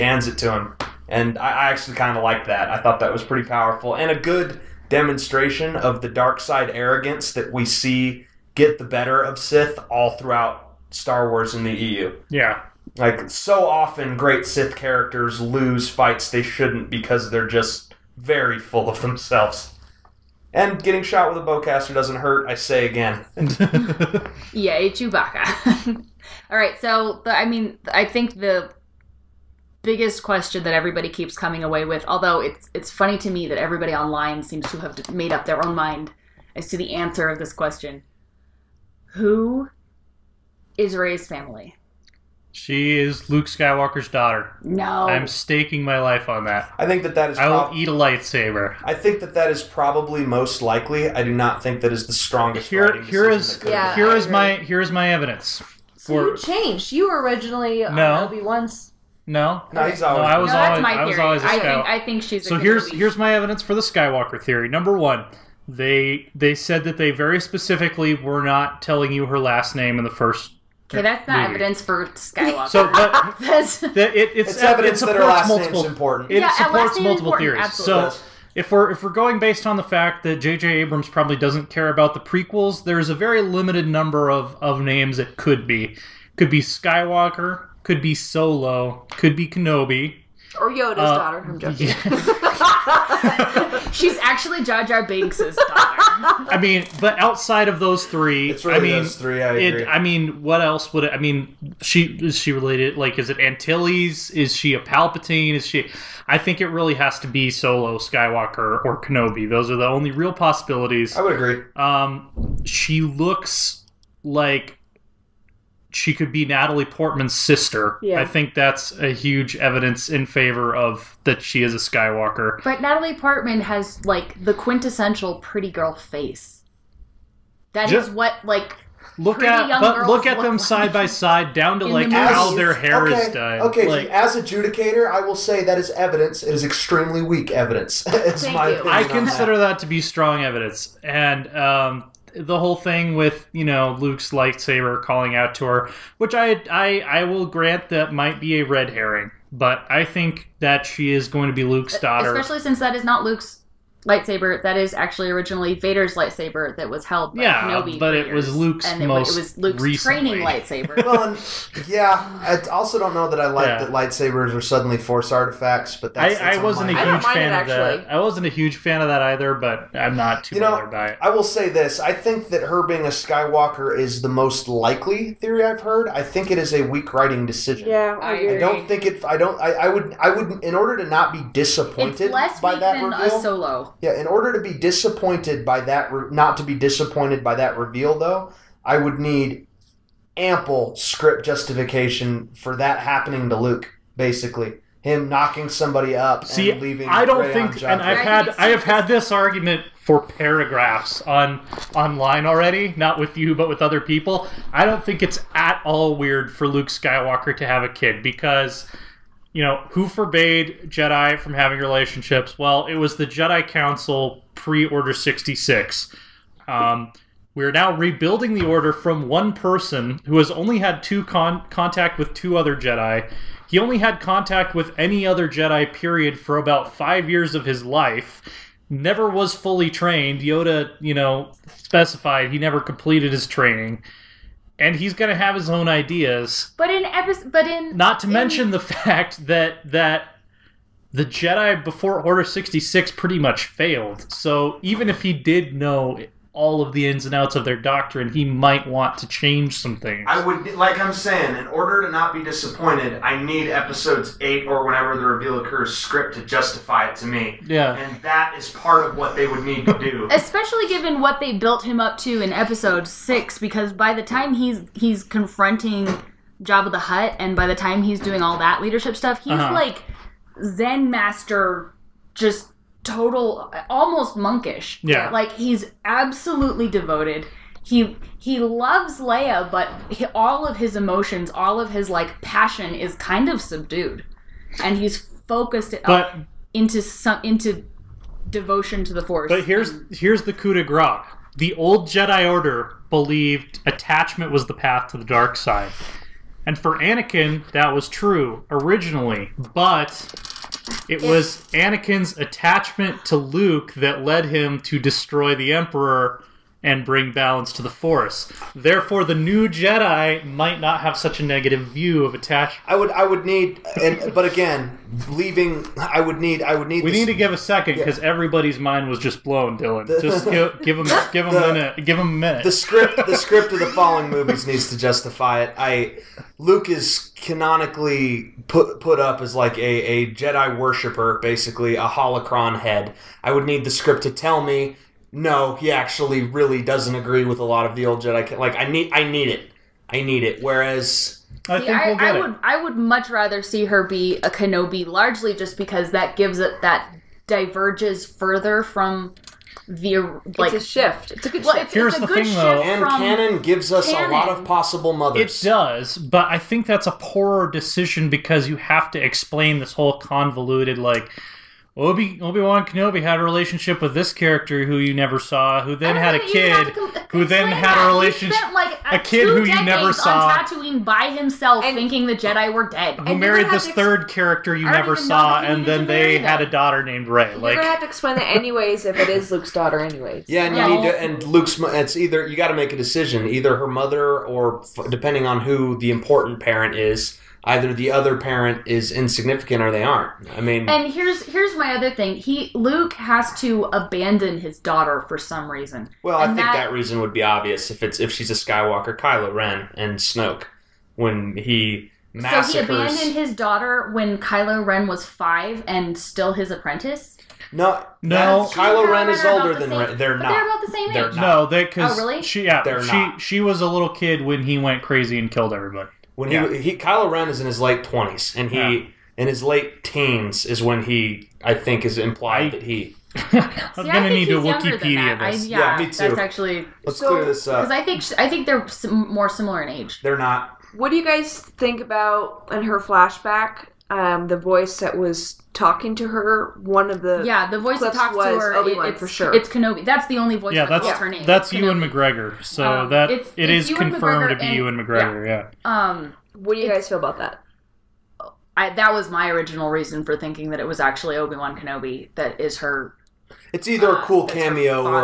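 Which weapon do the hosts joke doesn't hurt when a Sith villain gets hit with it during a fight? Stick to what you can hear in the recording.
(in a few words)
Bowcaster.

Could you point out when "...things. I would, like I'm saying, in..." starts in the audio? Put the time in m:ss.
4:09.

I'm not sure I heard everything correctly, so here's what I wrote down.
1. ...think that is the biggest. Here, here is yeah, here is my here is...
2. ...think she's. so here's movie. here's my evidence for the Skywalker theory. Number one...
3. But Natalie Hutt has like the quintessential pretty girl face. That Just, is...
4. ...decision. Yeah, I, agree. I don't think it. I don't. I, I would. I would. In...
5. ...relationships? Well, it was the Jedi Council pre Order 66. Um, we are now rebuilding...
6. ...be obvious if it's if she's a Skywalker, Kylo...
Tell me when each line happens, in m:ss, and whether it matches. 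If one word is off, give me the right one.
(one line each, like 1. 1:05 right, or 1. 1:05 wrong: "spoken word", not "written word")
1. 0:51 wrong: "strongest", not "biggest"
2. 1:02 right
3. 2:02 wrong: "Portman", not "Hutt"
4. 2:57 right
5. 3:31 right
6. 6:37 right.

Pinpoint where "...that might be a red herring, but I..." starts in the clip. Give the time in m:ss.
2:27.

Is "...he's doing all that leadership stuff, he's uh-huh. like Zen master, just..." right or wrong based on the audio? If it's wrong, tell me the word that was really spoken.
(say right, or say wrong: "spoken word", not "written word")
right.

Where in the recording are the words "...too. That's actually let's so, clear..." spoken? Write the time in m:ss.
7:06.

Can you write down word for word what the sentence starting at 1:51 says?
Um, she looks like she could be Natalie Portman's sister.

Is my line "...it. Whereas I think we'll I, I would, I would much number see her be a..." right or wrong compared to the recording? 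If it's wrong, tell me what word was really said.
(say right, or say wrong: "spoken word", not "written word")
wrong: "rather", not "number".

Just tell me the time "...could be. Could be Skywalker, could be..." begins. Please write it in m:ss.
1:25.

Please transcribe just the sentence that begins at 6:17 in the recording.
you like, going have to explain that anyways if it is Luke's daughter, anyways.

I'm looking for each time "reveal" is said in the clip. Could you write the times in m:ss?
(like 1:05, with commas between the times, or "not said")
3:03, 3:07, 4:15.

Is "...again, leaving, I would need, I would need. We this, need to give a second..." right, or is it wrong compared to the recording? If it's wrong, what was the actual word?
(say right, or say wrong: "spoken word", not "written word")
right.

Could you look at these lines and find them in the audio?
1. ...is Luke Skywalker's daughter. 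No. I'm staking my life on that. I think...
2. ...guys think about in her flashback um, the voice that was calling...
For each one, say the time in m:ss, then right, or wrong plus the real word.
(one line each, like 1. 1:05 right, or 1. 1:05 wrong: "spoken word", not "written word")
1. 0:42 right
2. 7:11 wrong: "talking", not "calling".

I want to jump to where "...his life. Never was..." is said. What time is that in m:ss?
3:47.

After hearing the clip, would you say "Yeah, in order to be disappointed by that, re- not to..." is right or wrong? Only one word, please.
right.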